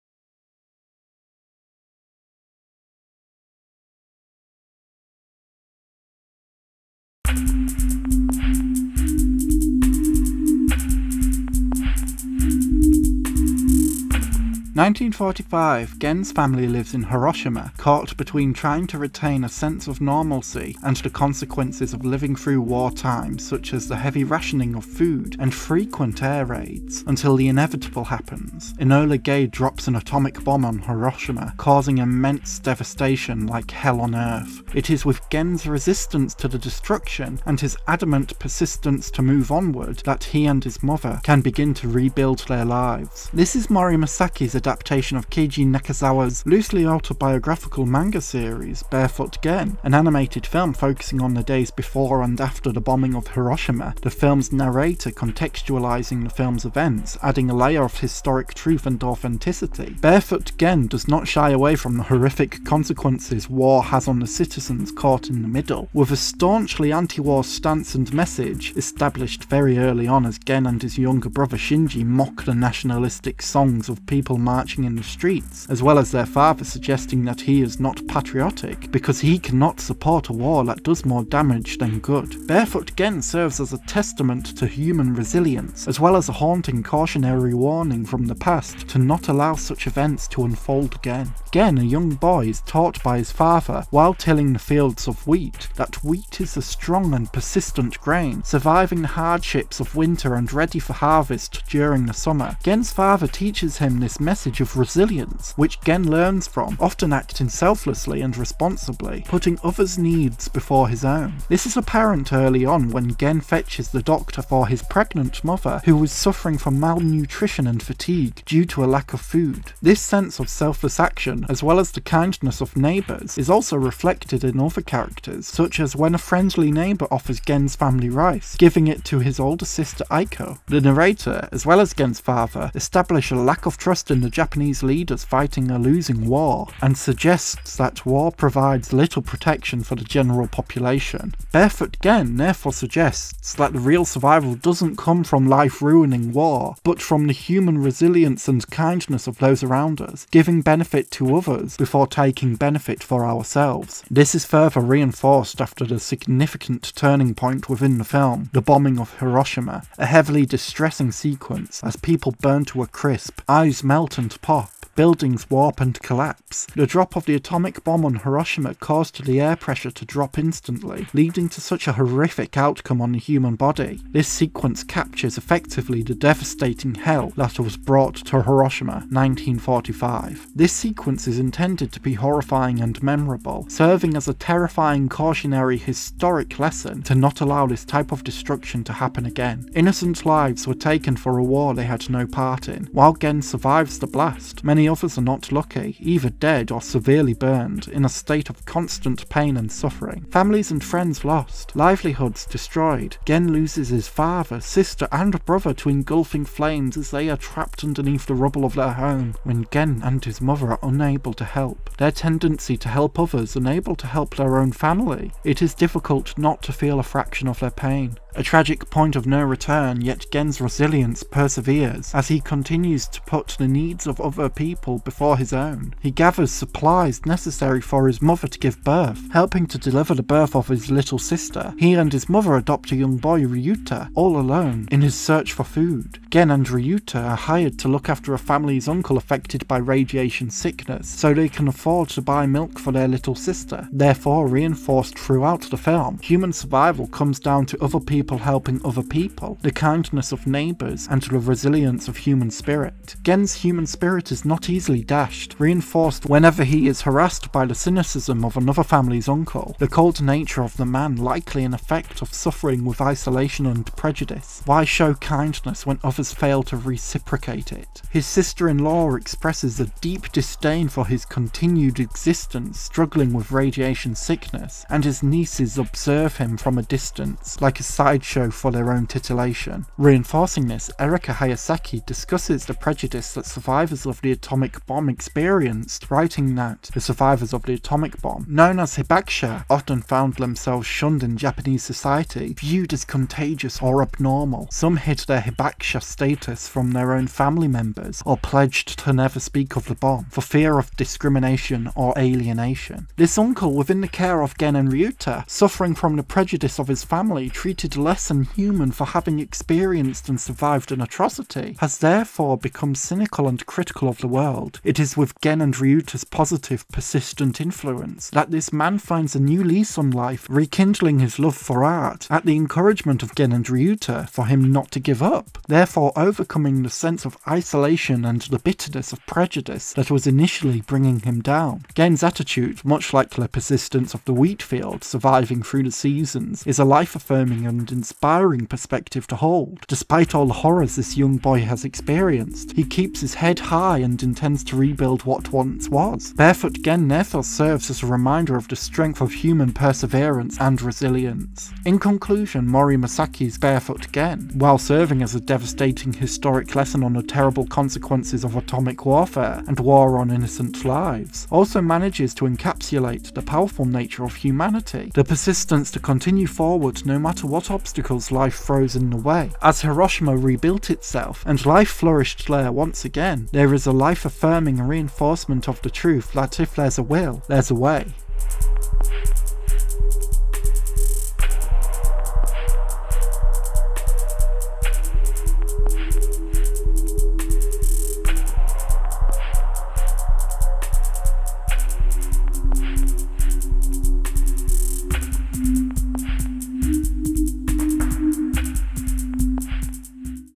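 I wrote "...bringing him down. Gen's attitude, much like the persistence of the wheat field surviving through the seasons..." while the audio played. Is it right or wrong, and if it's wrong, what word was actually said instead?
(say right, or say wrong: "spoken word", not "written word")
right.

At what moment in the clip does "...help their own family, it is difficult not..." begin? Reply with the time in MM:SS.
03:34.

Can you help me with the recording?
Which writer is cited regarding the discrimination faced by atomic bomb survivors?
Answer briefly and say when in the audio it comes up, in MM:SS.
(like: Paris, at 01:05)
Erika Hayasaki, at 04:40.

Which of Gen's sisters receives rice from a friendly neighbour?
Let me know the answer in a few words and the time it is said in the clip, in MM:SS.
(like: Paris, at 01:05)
Aiko, at 02:10.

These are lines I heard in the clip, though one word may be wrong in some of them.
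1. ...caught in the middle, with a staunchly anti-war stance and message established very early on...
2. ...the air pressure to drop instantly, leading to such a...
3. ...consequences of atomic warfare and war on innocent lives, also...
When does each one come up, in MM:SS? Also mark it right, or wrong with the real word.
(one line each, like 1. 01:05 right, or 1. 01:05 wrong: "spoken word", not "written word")
1. 01:04 right
2. 02:49 right
3. 05:57 right.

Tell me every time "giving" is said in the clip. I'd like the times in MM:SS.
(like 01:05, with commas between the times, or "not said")
02:08, 02:30.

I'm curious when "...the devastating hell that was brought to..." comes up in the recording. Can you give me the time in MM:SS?
02:56.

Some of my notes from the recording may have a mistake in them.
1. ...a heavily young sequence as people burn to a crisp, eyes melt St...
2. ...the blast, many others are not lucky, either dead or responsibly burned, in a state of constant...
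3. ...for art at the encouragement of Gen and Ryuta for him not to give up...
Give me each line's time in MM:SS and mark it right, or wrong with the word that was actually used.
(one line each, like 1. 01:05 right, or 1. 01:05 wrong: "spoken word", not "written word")
1. 02:39 wrong: "distressing", not "young"
2. 03:13 wrong: "severely", not "responsibly"
3. 05:21 right.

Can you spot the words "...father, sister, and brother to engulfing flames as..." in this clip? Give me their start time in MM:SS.
03:24.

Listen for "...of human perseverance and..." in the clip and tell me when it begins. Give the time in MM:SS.
05:49.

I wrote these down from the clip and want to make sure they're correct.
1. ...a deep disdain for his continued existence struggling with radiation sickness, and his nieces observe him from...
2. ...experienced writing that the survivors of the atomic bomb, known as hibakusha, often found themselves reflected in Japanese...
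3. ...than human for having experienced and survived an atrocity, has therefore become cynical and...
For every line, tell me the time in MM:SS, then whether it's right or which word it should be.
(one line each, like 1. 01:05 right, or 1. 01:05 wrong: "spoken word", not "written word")
1. 04:29 right
2. 04:45 wrong: "shunned", not "reflected"
3. 05:08 right.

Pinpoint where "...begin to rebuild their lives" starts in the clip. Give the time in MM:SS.
00:41.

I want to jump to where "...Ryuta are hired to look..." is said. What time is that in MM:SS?
03:56.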